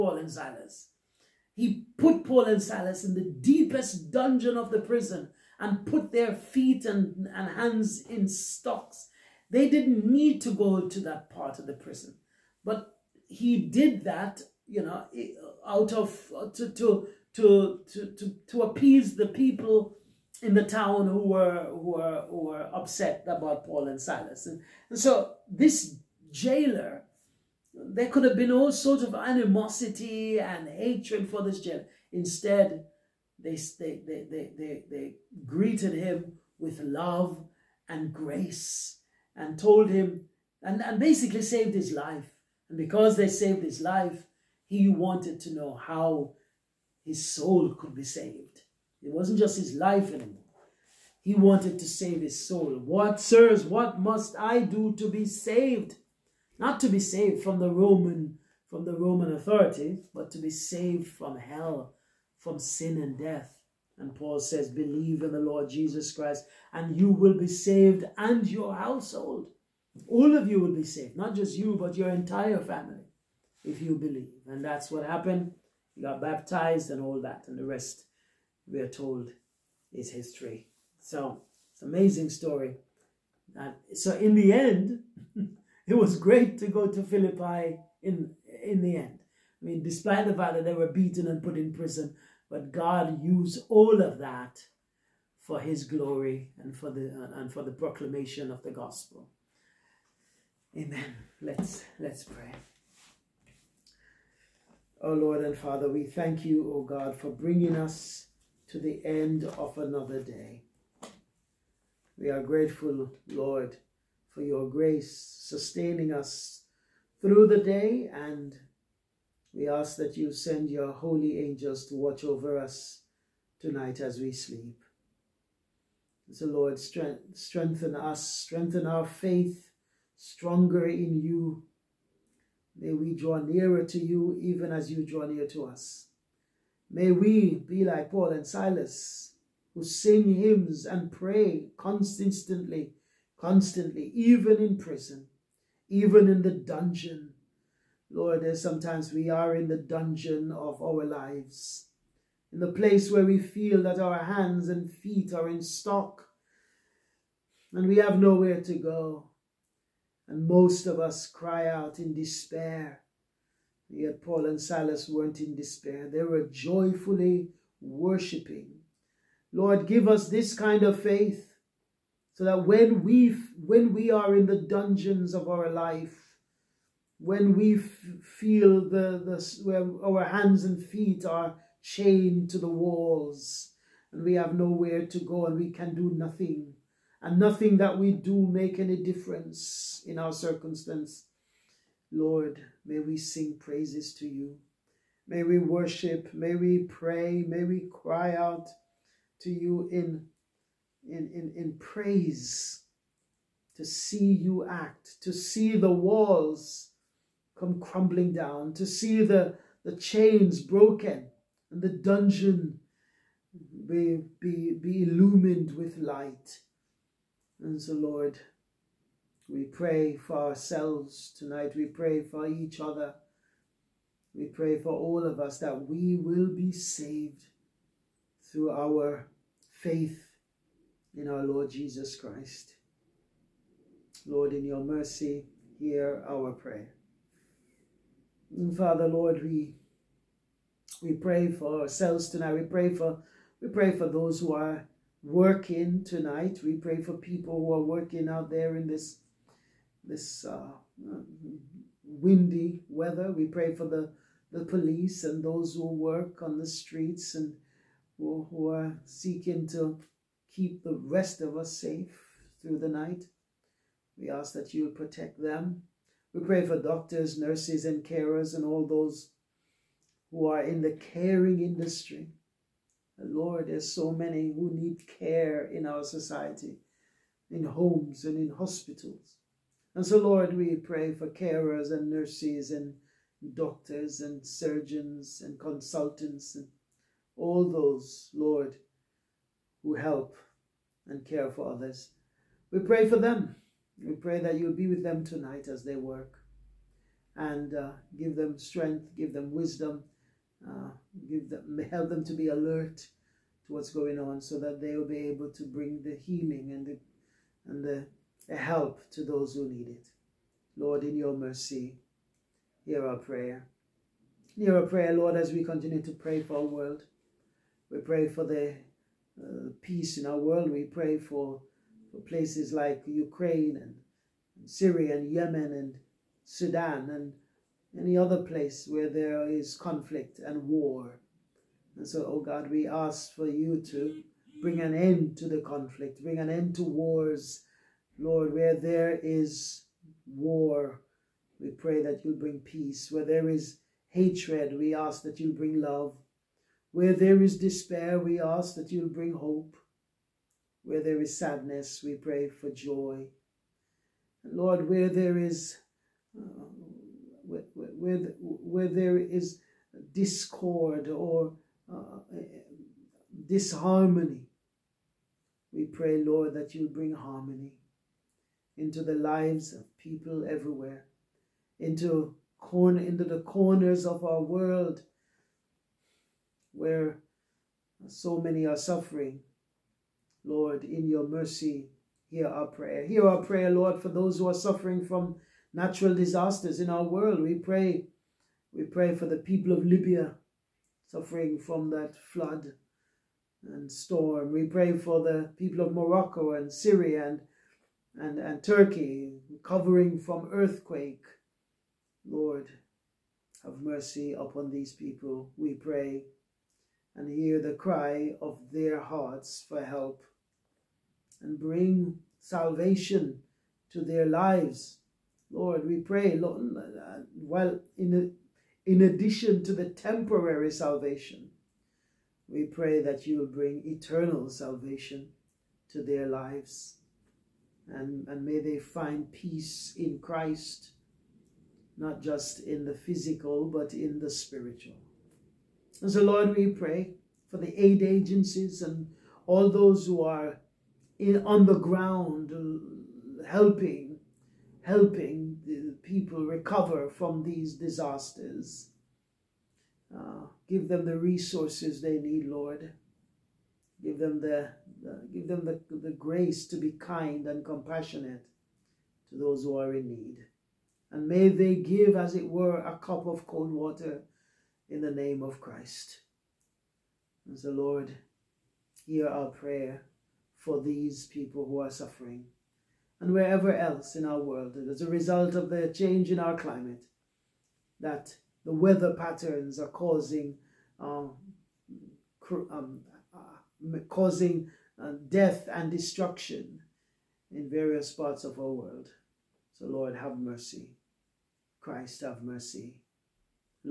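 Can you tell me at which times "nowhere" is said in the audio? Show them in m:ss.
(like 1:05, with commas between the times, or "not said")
2:38, 3:04.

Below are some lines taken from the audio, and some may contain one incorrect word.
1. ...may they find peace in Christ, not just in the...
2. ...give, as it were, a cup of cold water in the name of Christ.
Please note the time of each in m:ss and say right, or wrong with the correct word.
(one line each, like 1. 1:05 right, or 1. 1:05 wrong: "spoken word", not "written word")
1. 7:08 right
2. 7:41 right.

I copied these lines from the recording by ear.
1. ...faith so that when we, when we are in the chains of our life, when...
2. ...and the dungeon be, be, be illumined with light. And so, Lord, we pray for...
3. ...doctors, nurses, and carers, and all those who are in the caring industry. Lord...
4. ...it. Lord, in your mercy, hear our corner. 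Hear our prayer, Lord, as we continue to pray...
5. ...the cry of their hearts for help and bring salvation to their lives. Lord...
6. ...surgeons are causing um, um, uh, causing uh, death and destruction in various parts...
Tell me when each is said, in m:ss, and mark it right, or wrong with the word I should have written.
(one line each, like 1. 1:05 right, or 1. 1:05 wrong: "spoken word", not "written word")
1. 2:51 wrong: "dungeons", not "chains"
2. 3:31 right
3. 4:26 right
4. 5:09 wrong: "prayer", not "corner"
5. 6:47 right
6. 7:59 wrong: "patterns", not "surgeons".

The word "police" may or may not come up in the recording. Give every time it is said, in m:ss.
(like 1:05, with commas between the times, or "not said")
4:14.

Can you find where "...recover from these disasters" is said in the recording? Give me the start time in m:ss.
7:26.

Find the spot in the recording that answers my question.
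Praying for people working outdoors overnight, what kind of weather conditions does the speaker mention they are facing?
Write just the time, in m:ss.
4:12.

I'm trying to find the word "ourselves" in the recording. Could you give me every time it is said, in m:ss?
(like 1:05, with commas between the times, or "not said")
3:40, 4:01.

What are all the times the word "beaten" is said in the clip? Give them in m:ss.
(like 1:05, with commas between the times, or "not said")
1:30.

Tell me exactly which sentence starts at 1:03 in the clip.
And Paul says, Believe in the Lord Jesus Christ, and you will be saved and your household.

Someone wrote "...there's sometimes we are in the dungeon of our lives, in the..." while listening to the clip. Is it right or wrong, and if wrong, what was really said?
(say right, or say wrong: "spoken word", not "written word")
right.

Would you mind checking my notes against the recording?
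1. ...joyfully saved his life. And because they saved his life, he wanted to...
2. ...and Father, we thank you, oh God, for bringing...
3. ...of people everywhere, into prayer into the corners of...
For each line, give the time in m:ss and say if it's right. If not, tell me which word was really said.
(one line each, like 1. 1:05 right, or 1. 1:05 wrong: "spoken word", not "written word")
1. 0:40 wrong: "basically", not "joyfully"
2. 1:45 right
3. 6:09 wrong: "corner", not "prayer".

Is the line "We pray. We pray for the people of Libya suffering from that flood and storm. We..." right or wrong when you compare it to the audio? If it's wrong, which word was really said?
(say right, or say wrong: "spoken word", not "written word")
right.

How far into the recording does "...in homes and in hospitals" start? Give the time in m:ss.
4:37.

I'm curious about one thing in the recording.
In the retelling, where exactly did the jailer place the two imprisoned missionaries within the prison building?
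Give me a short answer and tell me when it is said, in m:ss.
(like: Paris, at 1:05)
deepest dungeon, at 0:03.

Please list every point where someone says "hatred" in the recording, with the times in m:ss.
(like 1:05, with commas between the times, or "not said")
0:30, 5:44.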